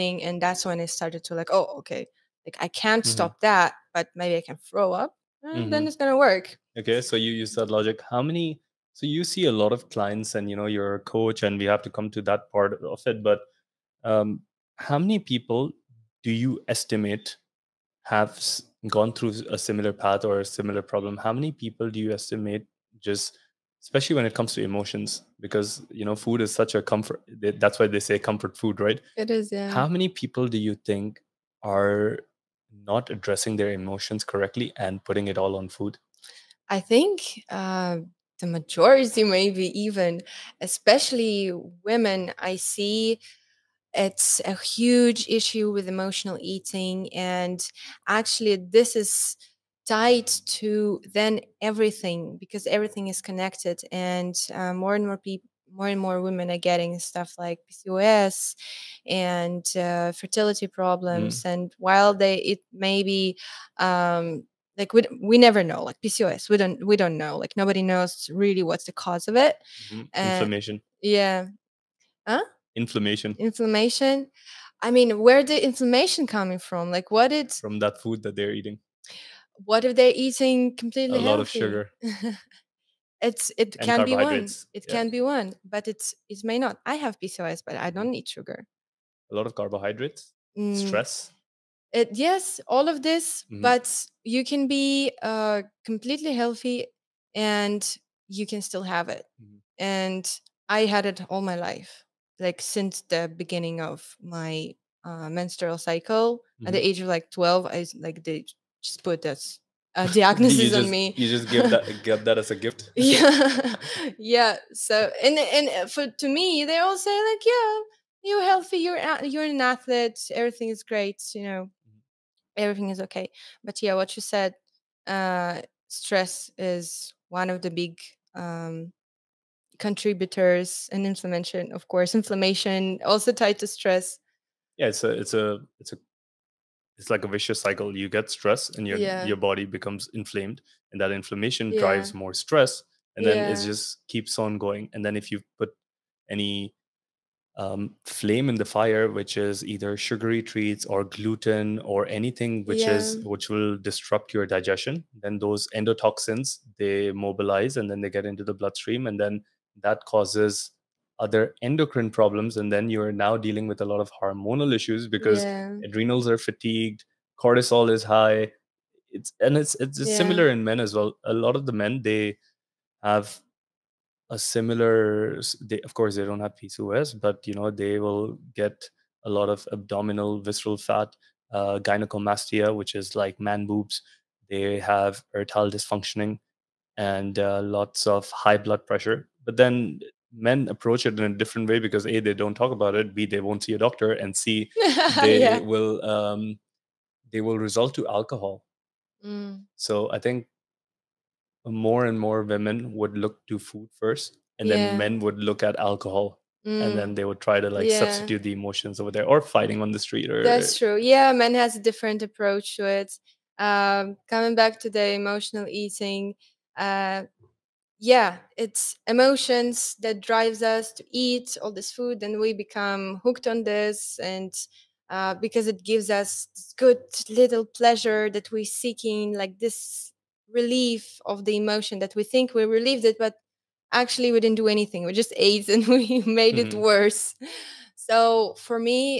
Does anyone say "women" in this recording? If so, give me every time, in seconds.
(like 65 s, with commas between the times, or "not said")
41 s, 56 s, 202 s.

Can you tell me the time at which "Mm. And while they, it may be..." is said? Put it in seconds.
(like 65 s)
61 s.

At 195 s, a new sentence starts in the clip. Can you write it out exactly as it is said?
will um they will result to alcohol mm.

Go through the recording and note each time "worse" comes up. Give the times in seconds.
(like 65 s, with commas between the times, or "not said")
236 s.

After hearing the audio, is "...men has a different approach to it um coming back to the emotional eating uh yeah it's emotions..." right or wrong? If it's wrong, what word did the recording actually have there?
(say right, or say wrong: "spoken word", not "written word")
right.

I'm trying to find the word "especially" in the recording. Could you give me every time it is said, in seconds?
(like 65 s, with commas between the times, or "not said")
23 s, 40 s.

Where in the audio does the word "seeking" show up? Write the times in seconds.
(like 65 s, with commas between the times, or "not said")
228 s.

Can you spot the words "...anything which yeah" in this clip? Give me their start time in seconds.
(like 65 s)
152 s.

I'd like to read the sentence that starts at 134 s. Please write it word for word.
Yeah, it's a it's a it's a it's like a vicious cycle.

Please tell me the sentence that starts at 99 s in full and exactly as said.
and i had it all my life like since the beginning of my uh, menstrual cycle mm-hmm.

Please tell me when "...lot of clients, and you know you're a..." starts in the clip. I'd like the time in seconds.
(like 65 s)
9 s.